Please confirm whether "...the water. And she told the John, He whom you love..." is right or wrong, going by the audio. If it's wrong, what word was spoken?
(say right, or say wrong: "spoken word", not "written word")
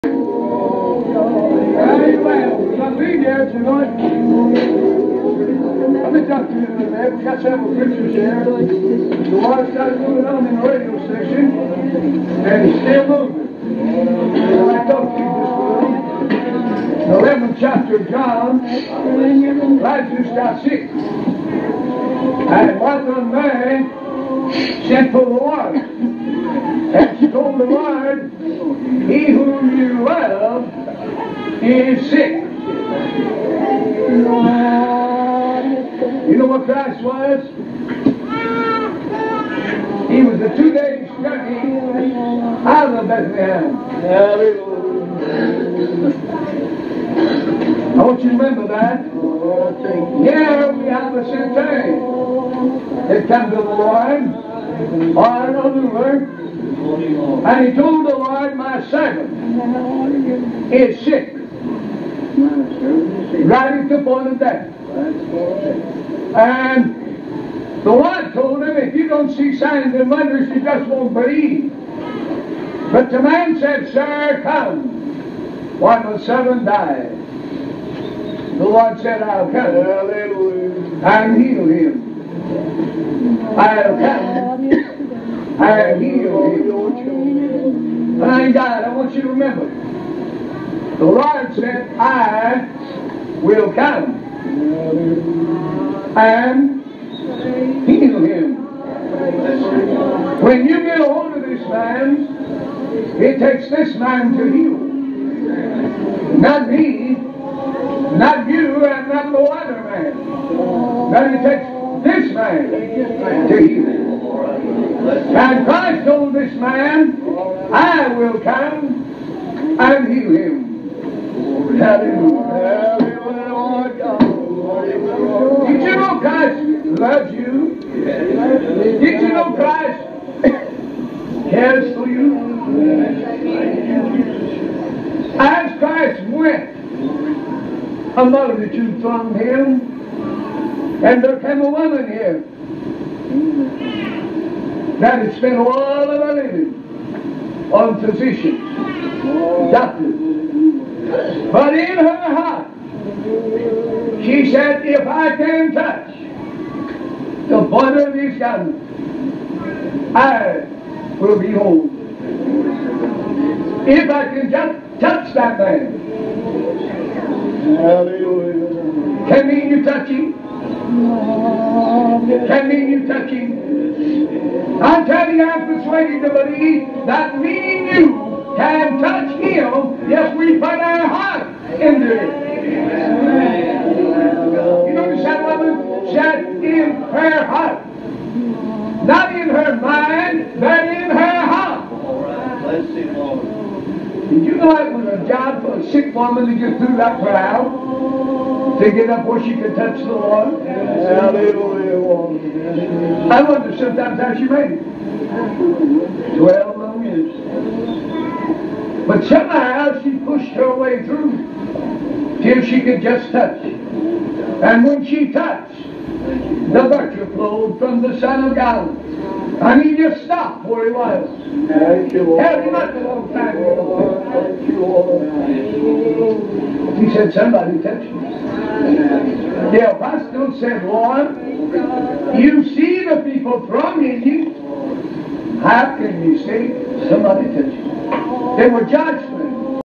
wrong: "Lord", not "John".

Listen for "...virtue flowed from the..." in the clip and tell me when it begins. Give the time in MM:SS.
03:36.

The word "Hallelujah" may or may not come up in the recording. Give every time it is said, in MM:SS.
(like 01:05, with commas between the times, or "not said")
01:19, 02:01, 03:20.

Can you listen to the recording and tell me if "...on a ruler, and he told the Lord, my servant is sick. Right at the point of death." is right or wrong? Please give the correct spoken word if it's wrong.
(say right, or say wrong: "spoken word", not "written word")
right.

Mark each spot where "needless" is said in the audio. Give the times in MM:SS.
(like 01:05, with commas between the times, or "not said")
not said.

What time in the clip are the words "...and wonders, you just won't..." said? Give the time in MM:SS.
01:09.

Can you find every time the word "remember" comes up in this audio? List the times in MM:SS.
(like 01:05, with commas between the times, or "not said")
00:48, 01:29.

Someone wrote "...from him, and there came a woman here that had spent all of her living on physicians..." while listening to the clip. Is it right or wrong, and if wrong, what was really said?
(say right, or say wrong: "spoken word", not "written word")
right.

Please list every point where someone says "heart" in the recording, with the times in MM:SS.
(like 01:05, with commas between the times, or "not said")
02:32, 03:01, 03:07, 03:11.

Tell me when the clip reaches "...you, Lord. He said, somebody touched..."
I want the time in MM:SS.
03:44.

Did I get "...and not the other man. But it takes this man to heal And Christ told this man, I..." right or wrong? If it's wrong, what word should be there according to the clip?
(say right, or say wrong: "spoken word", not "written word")
right.